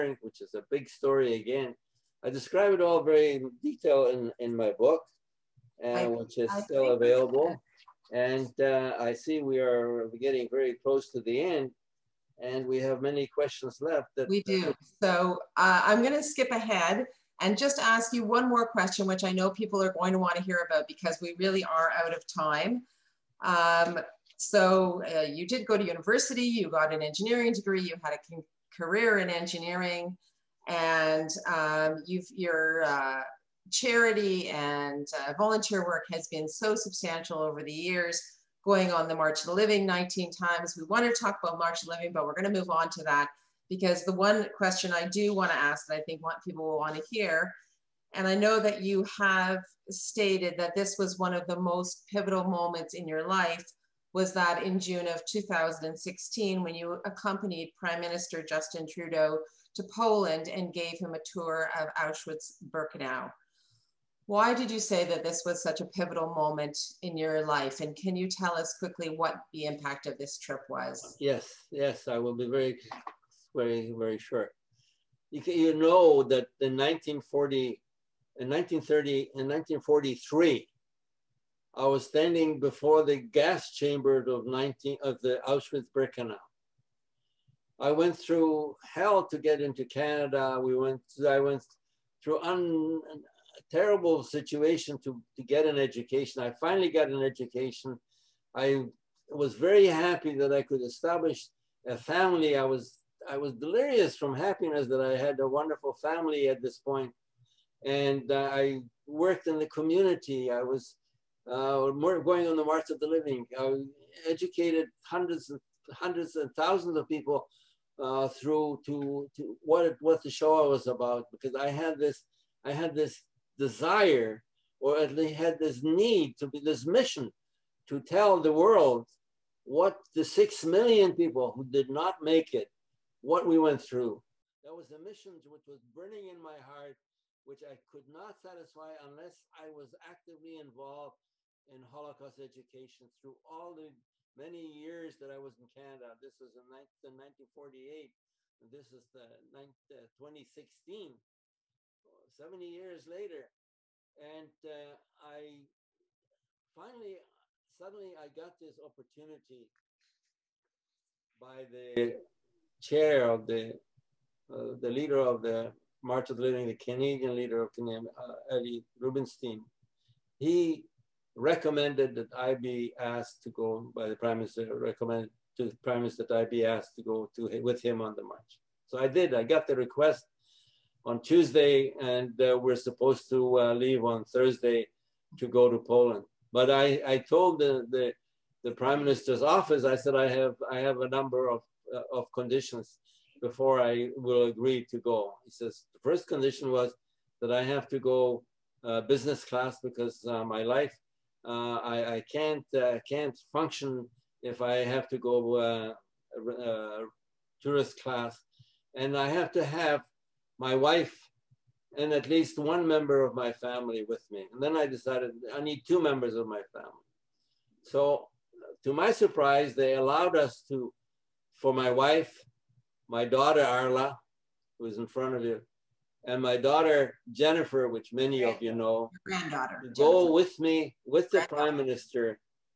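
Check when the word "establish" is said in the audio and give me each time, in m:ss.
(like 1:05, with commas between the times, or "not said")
1:40.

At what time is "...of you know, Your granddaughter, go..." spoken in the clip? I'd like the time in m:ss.
3:48.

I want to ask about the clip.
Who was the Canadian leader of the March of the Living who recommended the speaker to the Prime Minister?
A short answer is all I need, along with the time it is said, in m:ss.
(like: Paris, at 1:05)
Eddie Rubinstein, at 2:48.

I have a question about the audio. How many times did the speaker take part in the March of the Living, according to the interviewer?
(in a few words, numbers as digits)
19.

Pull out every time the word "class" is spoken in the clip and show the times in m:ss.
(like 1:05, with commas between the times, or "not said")
3:19, 3:28.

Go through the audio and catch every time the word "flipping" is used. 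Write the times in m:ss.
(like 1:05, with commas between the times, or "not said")
not said.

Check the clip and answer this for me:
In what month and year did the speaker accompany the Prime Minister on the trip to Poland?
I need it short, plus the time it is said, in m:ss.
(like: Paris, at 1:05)
June 2016, at 0:54.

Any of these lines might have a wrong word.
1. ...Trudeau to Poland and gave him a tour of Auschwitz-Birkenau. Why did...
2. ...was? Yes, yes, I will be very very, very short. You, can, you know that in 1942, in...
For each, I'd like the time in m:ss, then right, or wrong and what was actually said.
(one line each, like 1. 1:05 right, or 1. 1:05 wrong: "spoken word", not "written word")
1. 0:58 right
2. 1:10 wrong: "1940", not "1942".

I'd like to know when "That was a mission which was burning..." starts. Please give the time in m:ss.
2:14.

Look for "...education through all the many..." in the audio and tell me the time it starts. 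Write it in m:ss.
2:22.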